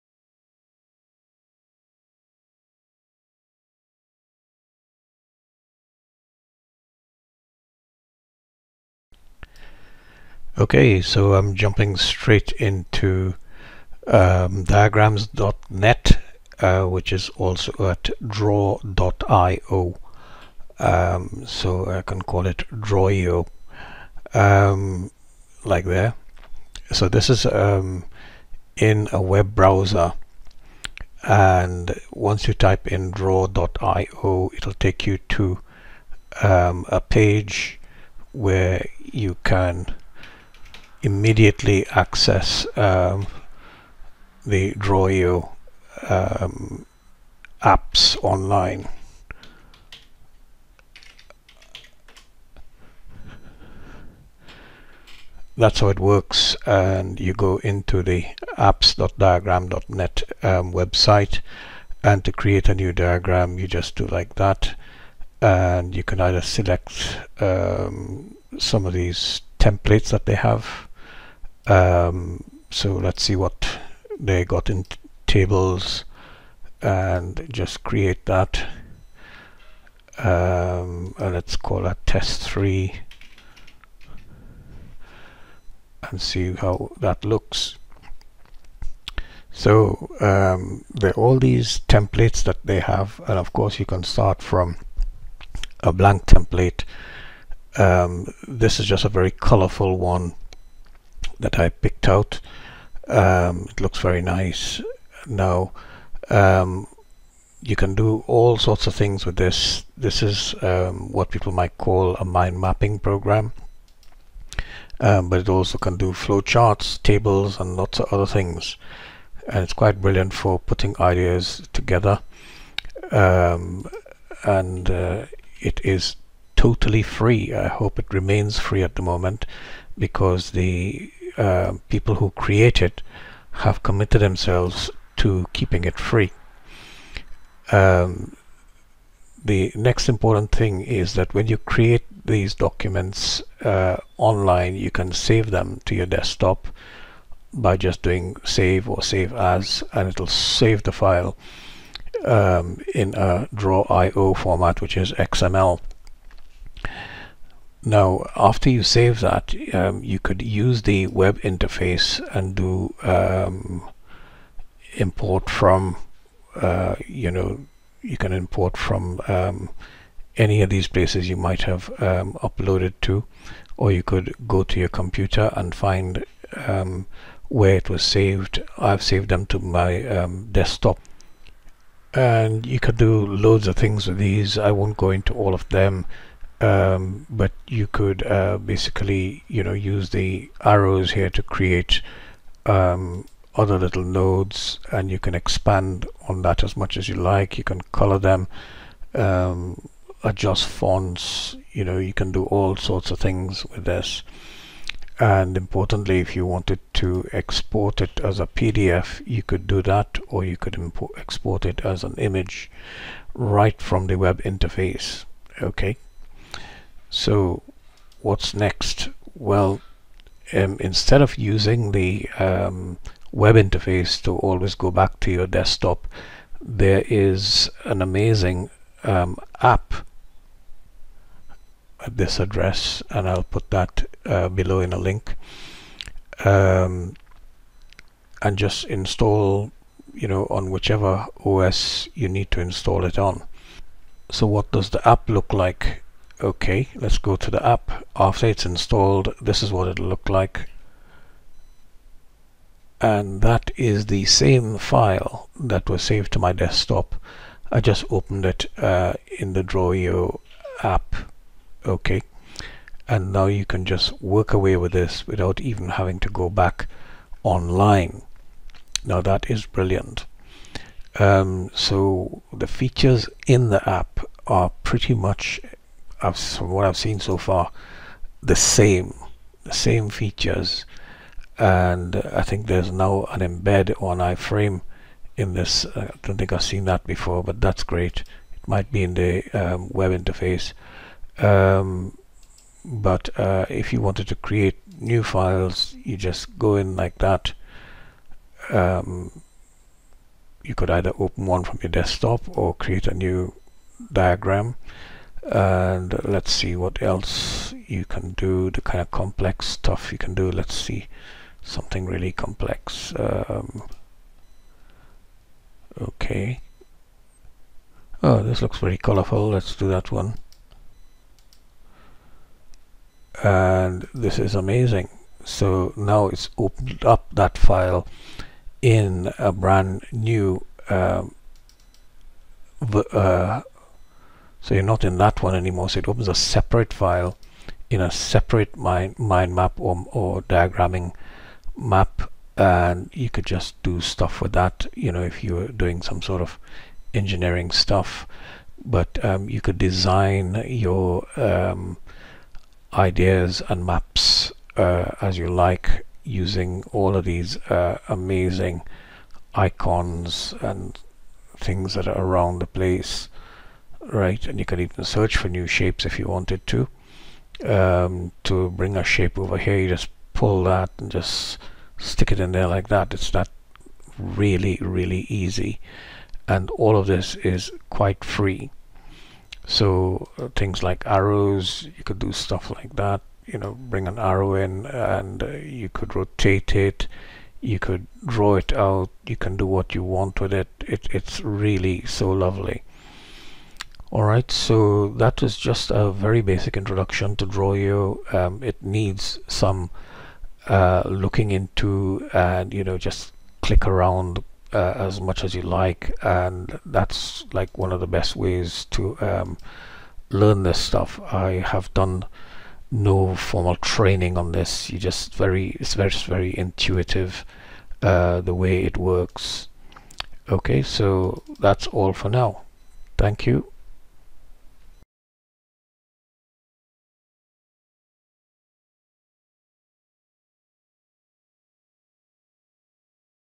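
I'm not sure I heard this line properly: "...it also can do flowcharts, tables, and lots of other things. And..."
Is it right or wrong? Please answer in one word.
right.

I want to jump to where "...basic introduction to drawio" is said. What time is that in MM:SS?
06:36.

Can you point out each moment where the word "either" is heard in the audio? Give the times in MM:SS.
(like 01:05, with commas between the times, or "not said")
01:06, 05:00.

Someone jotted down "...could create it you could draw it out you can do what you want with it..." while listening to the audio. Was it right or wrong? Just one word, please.
wrong.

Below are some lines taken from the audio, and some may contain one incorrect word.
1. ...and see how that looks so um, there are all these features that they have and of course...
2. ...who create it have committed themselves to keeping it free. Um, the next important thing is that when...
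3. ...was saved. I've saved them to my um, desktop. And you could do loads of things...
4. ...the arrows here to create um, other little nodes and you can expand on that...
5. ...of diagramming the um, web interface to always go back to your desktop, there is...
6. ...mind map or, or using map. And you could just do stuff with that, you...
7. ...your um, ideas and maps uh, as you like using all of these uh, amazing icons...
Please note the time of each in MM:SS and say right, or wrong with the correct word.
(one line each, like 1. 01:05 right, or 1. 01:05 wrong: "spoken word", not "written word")
1. 01:26 wrong: "templates", not "features"
2. 02:12 right
3. 02:57 right
4. 03:10 right
5. 03:41 wrong: "using", not "diagramming"
6. 05:39 wrong: "diagramming", not "using"
7. 05:50 right.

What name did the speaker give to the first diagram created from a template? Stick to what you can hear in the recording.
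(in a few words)
test 3.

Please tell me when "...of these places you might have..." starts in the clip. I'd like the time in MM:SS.
02:50.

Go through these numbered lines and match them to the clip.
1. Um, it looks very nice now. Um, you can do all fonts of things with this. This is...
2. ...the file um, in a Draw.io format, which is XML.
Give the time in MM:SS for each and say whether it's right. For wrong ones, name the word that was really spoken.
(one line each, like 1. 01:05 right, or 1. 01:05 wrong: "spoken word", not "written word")
1. 01:43 wrong: "sorts", not "fonts"
2. 02:30 right.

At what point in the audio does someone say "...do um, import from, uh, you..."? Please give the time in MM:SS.
02:42.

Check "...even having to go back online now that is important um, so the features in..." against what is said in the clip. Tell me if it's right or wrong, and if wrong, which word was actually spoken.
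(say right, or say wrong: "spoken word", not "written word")
wrong: "brilliant", not "important".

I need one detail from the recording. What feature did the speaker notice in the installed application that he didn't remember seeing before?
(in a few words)
embed on iframe.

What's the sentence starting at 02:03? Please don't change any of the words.
Um, and uh, it is totally free.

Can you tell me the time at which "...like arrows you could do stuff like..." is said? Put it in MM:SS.
06:20.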